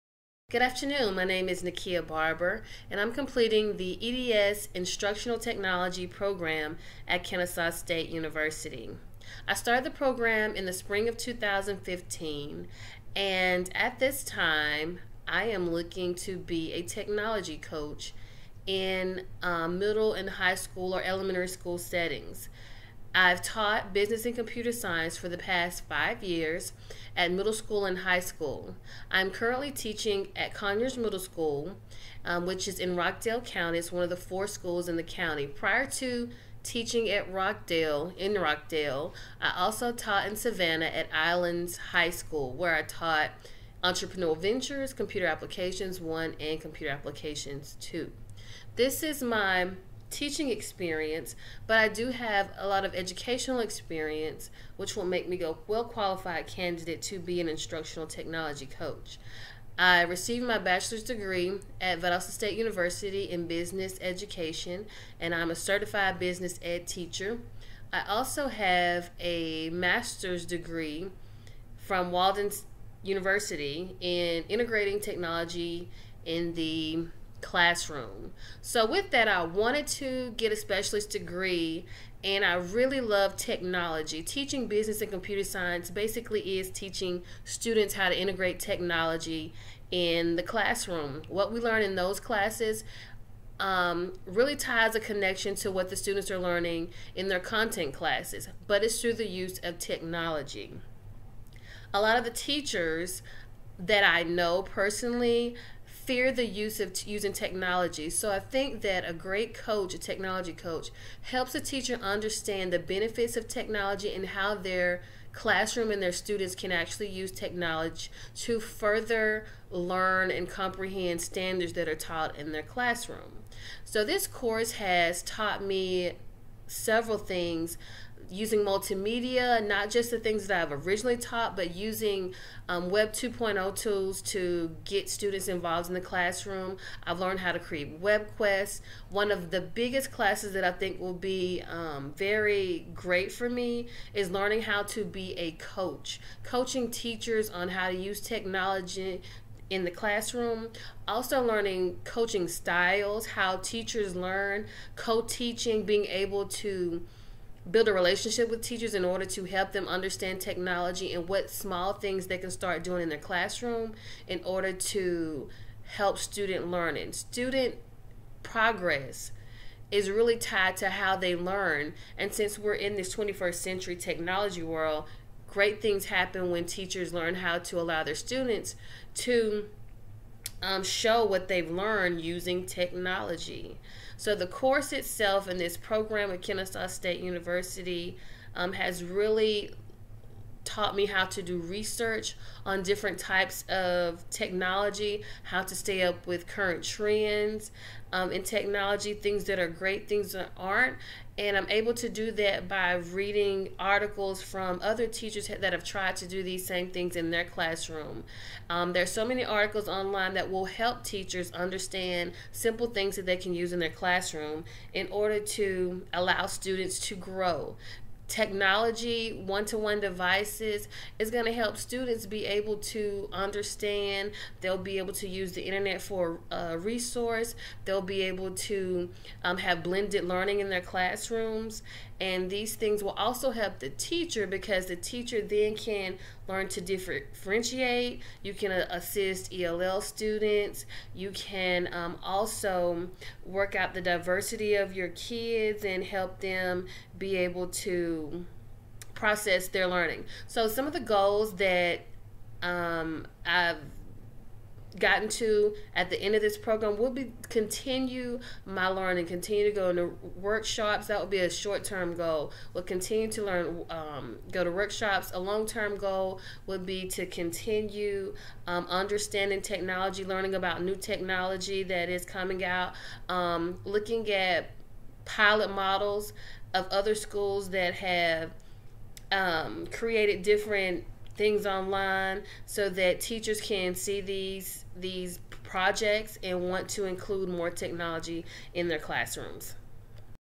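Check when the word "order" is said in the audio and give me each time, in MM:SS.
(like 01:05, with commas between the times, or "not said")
02:39, 02:44, 03:35.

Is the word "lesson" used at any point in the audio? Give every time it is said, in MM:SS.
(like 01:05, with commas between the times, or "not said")
not said.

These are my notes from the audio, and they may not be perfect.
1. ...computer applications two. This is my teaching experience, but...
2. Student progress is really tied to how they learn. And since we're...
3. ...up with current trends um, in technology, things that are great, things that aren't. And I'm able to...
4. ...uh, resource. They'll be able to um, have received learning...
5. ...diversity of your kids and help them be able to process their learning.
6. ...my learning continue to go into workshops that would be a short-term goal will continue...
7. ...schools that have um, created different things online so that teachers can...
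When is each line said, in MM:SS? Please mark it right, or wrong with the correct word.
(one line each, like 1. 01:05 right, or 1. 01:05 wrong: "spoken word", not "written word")
1. 00:46 right
2. 02:47 right
3. 03:16 right
4. 03:46 wrong: "blended", not "received"
5. 04:04 right
6. 04:18 right
7. 04:37 right.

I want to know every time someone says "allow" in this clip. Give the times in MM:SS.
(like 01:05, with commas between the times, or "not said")
02:57, 03:36.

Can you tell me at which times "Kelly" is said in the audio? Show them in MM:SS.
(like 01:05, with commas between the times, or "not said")
not said.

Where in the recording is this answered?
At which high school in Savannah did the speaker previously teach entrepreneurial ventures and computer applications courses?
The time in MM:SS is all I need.
00:41.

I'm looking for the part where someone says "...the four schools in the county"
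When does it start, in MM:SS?
00:34.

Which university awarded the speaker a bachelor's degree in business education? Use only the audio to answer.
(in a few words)
Valdosta State University.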